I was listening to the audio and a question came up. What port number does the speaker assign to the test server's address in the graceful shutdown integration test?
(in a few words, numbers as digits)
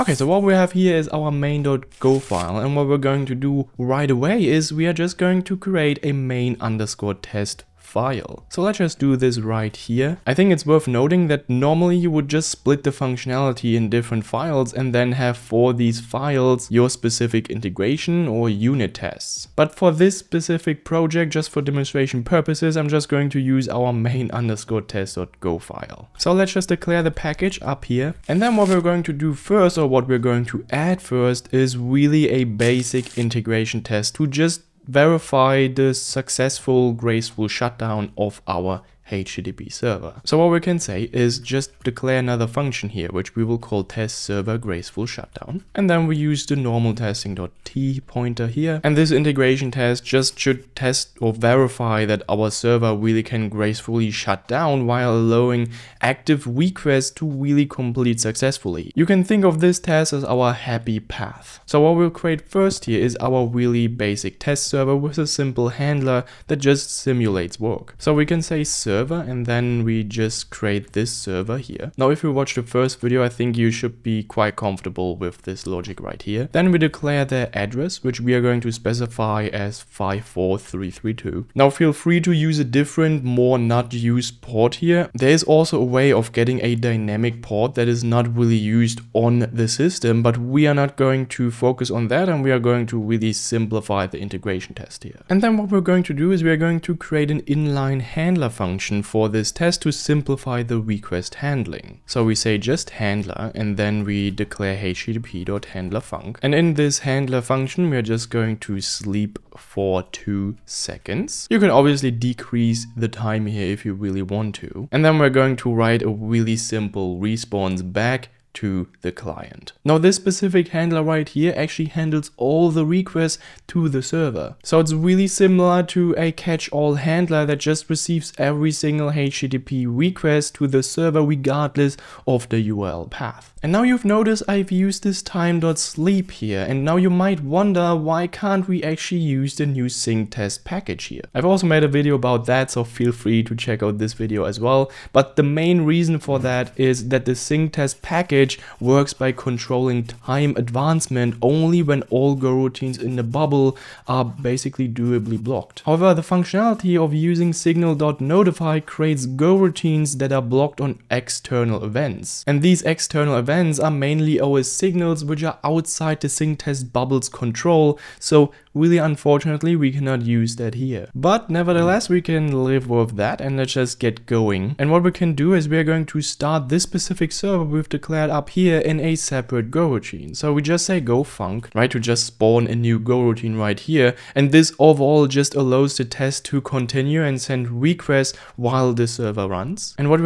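54332.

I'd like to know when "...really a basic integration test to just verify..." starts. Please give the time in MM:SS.
00:31.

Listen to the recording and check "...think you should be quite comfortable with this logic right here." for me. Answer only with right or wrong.
right.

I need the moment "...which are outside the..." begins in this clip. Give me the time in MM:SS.
02:45.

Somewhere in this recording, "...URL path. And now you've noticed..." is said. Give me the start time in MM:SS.
02:12.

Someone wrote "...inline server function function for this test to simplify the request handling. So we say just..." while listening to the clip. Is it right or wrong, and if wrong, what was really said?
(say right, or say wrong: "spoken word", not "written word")
wrong: "handler", not "server".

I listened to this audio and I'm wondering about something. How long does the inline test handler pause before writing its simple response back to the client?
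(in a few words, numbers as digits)
2 seconds.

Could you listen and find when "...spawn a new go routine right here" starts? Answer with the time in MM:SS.
03:02.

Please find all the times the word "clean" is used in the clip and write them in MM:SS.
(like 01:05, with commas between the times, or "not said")
not said.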